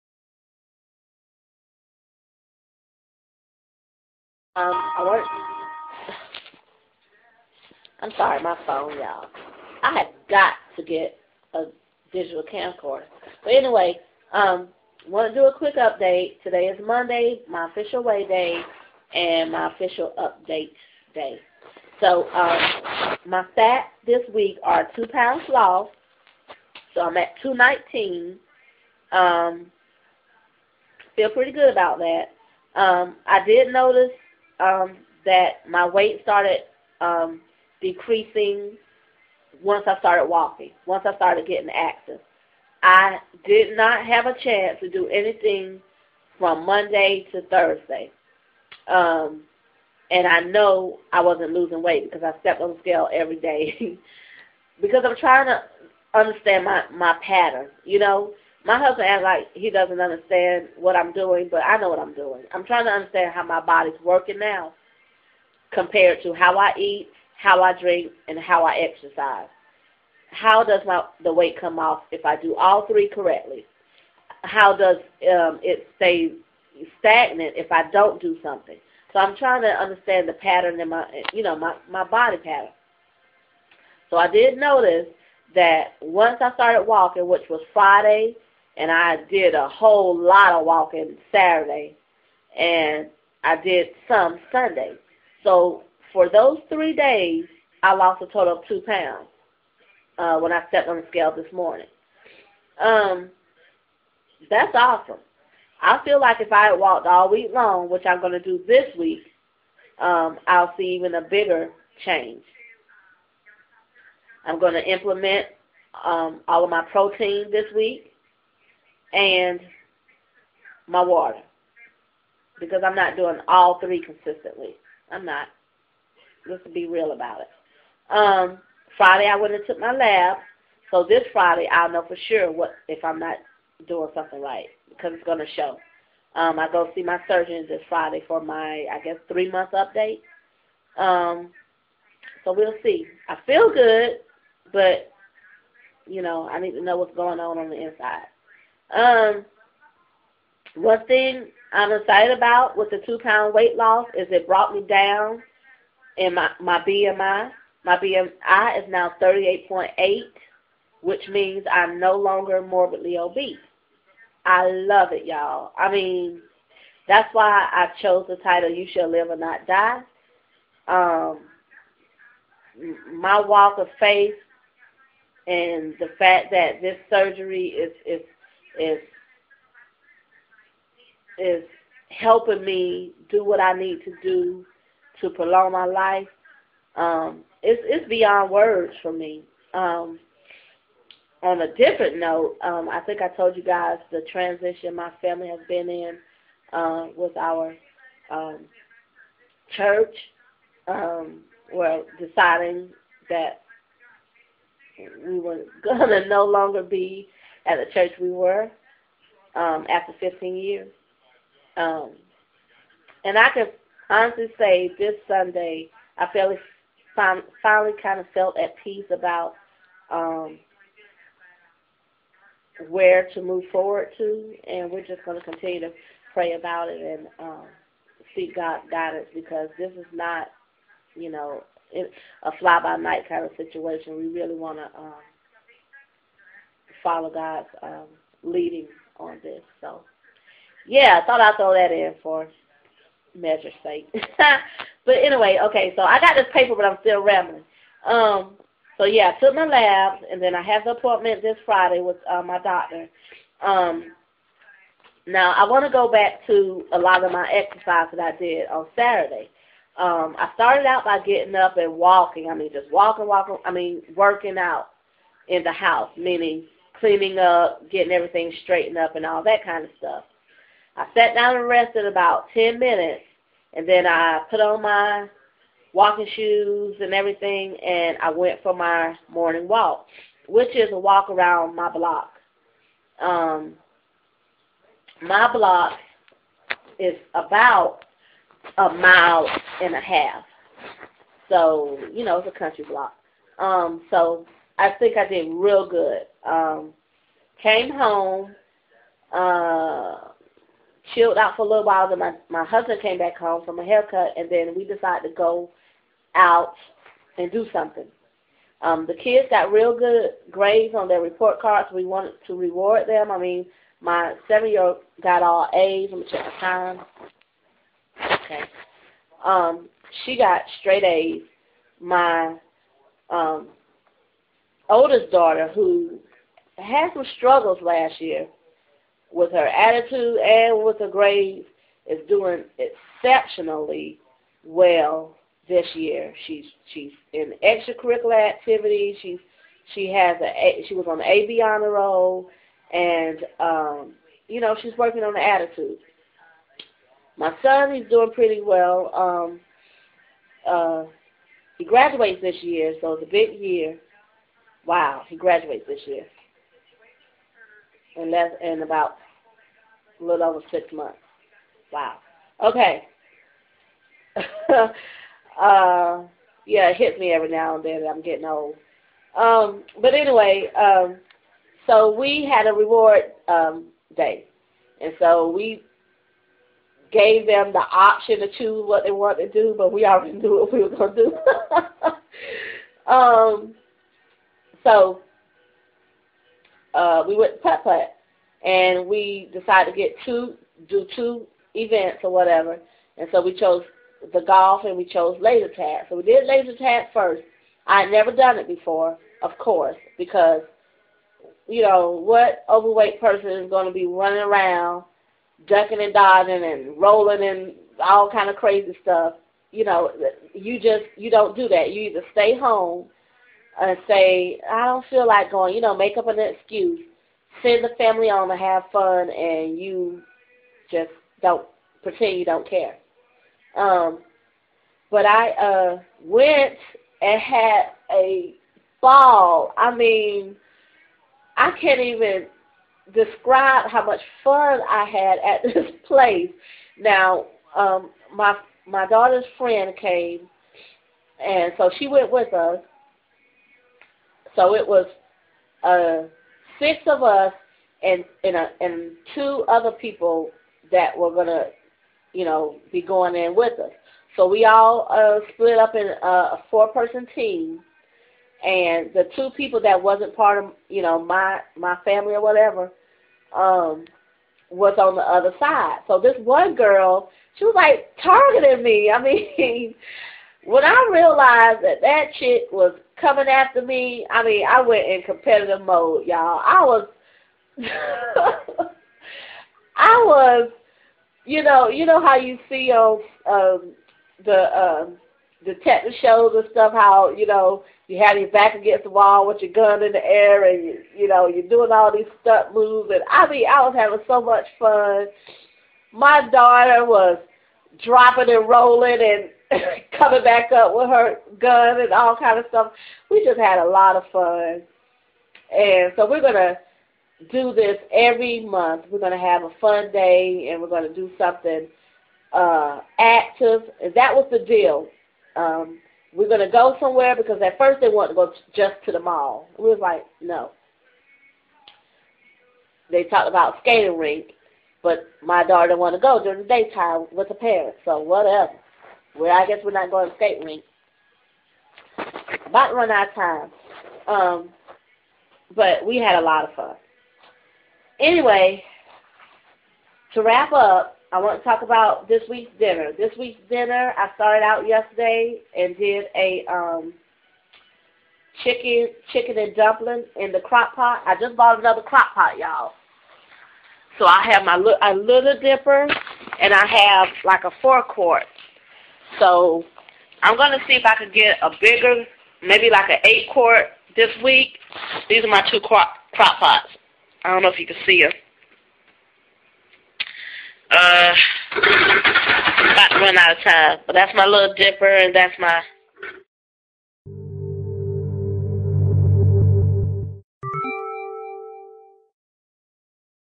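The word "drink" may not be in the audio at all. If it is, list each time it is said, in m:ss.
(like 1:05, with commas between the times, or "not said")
1:07.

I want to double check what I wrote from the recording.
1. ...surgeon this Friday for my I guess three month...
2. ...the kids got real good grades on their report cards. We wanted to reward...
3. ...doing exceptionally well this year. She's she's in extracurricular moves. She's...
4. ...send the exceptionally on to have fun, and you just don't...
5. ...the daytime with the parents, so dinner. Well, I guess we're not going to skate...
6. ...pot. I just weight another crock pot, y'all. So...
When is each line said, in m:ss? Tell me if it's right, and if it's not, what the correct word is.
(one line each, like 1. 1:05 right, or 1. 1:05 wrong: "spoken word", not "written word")
1. 2:17 right
2. 5:09 right
3. 5:32 wrong: "activities", not "moves"
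4. 6:57 wrong: "family", not "exceptionally"
5. 8:46 wrong: "whatever", not "dinner"
6. 9:10 wrong: "bought", not "weight".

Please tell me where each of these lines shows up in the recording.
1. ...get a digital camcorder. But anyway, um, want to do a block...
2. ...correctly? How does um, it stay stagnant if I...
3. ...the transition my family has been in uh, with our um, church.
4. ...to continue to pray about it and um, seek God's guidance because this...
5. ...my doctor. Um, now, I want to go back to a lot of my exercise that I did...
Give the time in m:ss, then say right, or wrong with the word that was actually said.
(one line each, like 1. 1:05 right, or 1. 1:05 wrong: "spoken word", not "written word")
1. 0:10 wrong: "quick", not "block"
2. 1:13 right
3. 3:14 right
4. 3:45 right
5. 4:12 right.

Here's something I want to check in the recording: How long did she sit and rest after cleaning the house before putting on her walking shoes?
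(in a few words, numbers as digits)
10 minutes.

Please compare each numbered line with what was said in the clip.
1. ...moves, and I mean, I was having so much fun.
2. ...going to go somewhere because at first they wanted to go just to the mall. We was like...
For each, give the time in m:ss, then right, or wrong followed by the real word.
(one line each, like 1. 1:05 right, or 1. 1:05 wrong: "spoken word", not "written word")
1. 8:12 right
2. 8:36 right.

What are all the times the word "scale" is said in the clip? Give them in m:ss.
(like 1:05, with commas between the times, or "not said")
0:52, 1:41.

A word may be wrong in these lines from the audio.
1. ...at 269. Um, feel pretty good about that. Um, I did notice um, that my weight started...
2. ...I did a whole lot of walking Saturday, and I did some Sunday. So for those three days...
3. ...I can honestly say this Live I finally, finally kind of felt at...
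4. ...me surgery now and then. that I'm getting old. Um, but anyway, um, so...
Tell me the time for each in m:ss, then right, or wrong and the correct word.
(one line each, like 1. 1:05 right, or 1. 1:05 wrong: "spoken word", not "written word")
1. 0:27 wrong: "219", not "269"
2. 1:28 right
3. 3:33 wrong: "Sunday", not "Live"
4. 6:07 wrong: "every", not "surgery".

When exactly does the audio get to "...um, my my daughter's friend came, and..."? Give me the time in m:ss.
7:17.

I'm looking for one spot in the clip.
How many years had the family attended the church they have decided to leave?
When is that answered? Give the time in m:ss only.
3:30.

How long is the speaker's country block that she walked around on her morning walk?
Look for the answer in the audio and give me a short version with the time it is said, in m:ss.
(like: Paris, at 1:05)
1.5 miles, at 4:48.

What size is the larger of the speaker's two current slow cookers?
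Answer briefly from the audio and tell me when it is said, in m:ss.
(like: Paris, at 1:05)
4 quart, at 9:17.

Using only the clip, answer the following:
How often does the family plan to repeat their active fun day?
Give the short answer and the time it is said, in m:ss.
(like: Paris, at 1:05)
every month, at 8:28.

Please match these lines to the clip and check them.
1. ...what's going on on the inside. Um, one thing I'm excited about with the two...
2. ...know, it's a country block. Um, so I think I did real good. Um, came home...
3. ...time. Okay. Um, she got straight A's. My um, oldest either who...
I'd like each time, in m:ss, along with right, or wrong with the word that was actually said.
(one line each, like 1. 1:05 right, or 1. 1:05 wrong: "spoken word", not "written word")
1. 2:26 right
2. 4:52 right
3. 5:16 wrong: "daughter", not "either".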